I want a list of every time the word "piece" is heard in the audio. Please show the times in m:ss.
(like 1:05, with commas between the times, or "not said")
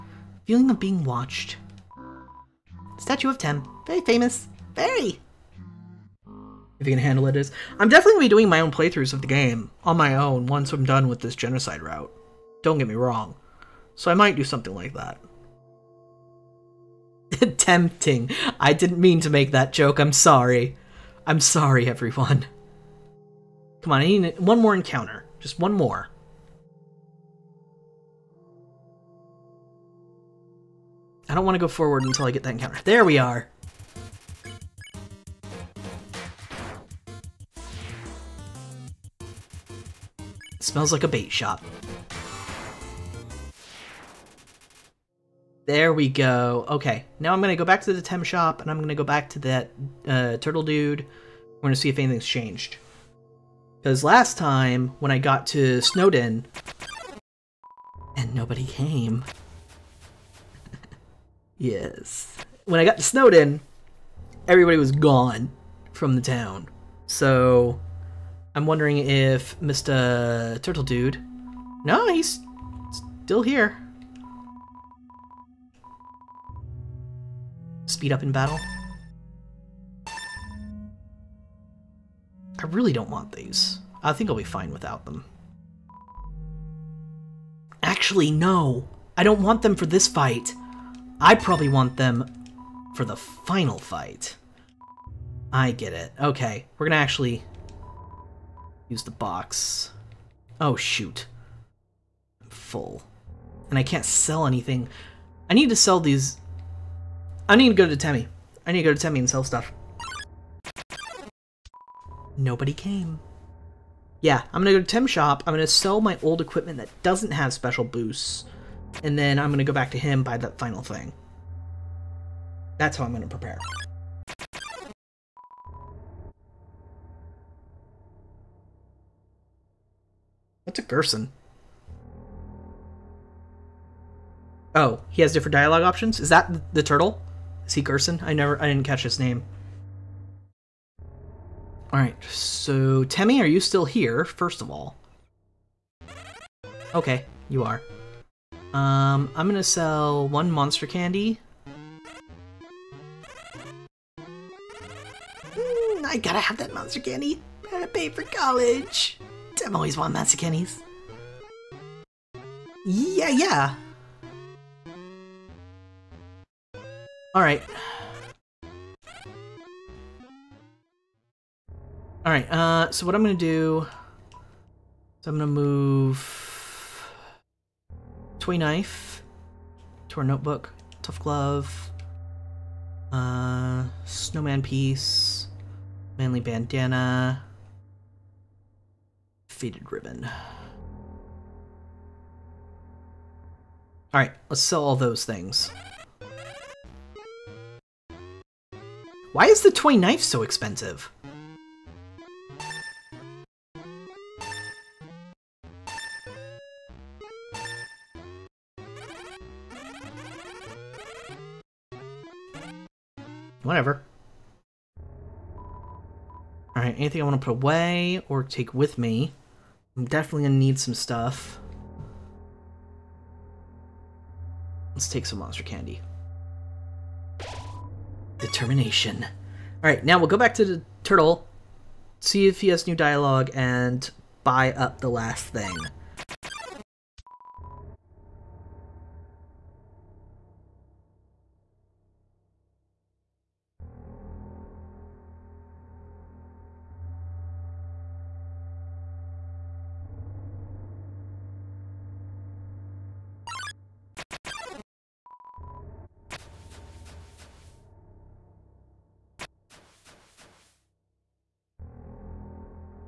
3:04.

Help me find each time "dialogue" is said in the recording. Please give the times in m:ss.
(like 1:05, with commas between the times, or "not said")
2:15, 3:52.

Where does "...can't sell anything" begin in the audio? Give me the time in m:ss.
1:43.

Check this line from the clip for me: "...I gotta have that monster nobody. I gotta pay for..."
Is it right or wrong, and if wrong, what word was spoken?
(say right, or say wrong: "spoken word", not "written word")
wrong: "candy", not "nobody".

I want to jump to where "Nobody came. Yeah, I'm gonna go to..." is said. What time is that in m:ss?
1:52.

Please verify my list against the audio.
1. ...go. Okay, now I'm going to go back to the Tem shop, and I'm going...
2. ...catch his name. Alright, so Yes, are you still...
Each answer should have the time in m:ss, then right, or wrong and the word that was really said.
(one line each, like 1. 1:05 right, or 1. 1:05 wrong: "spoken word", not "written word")
1. 0:46 right
2. 2:18 wrong: "Temmie", not "Yes".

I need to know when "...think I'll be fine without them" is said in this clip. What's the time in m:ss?
1:24.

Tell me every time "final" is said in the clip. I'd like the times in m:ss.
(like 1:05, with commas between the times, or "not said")
1:33, 2:00.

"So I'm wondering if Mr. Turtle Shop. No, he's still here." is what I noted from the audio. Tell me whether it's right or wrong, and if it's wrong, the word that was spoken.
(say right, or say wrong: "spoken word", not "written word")
wrong: "Dude", not "Shop".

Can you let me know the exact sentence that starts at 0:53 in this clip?
Because last time, when I got to Snowdin, and nobody came, Yes.